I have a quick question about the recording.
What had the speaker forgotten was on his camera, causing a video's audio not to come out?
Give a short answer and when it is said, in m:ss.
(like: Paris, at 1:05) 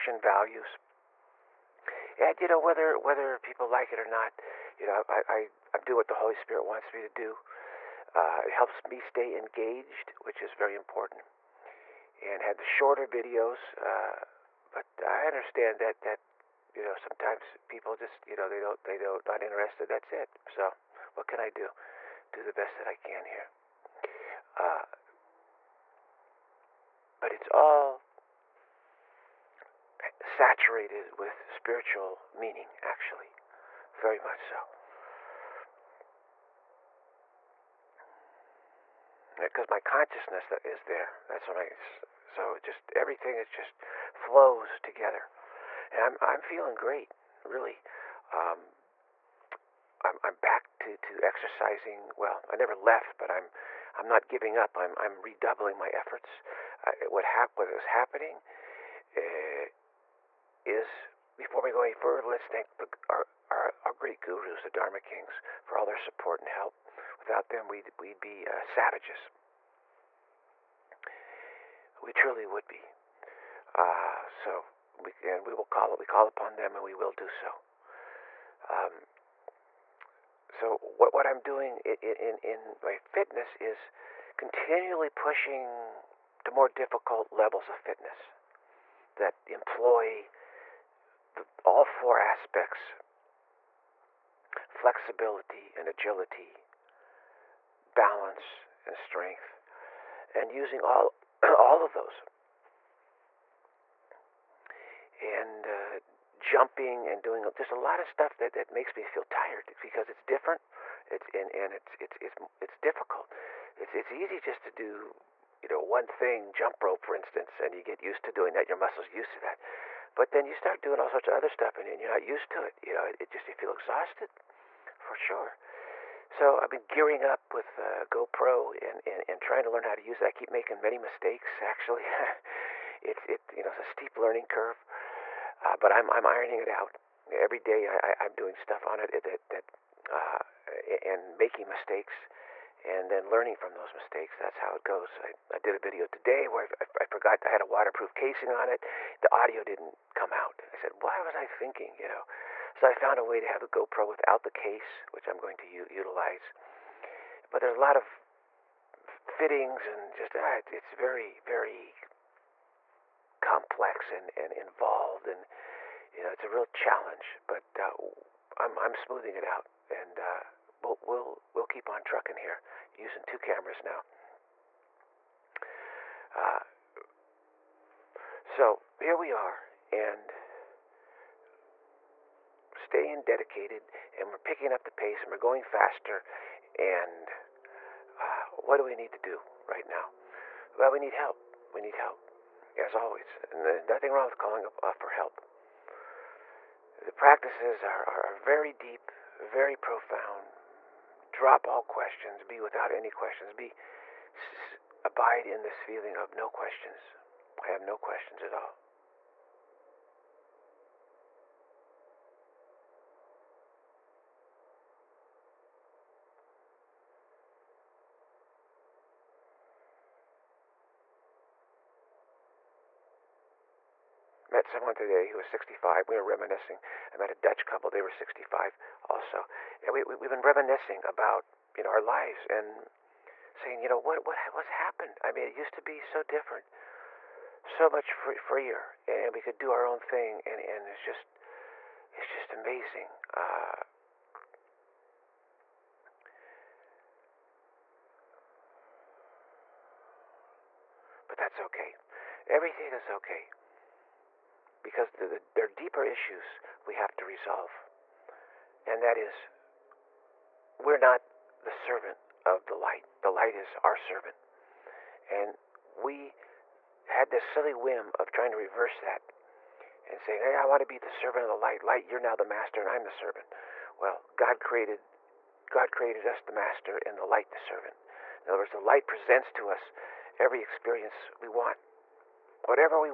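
Waterproof casing, at 2:27.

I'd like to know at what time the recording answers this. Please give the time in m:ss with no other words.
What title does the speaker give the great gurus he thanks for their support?
1:04.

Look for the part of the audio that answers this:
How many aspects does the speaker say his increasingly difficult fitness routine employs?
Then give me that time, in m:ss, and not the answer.
1:31.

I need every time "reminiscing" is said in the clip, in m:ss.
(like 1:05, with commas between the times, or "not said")
3:46, 3:50.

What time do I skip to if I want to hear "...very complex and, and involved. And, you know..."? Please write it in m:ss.
2:41.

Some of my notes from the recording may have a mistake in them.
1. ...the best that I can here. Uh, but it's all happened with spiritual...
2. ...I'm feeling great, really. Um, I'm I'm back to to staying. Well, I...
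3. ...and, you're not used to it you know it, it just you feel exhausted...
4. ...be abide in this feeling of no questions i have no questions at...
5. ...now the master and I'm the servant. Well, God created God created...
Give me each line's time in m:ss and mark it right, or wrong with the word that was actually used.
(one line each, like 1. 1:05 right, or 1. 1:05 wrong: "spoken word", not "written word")
1. 0:22 wrong: "saturated", not "happened"
2. 0:46 wrong: "exercising", not "staying"
3. 2:01 right
4. 3:23 right
5. 4:32 right.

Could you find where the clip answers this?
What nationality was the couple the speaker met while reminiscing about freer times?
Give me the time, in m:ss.
3:47.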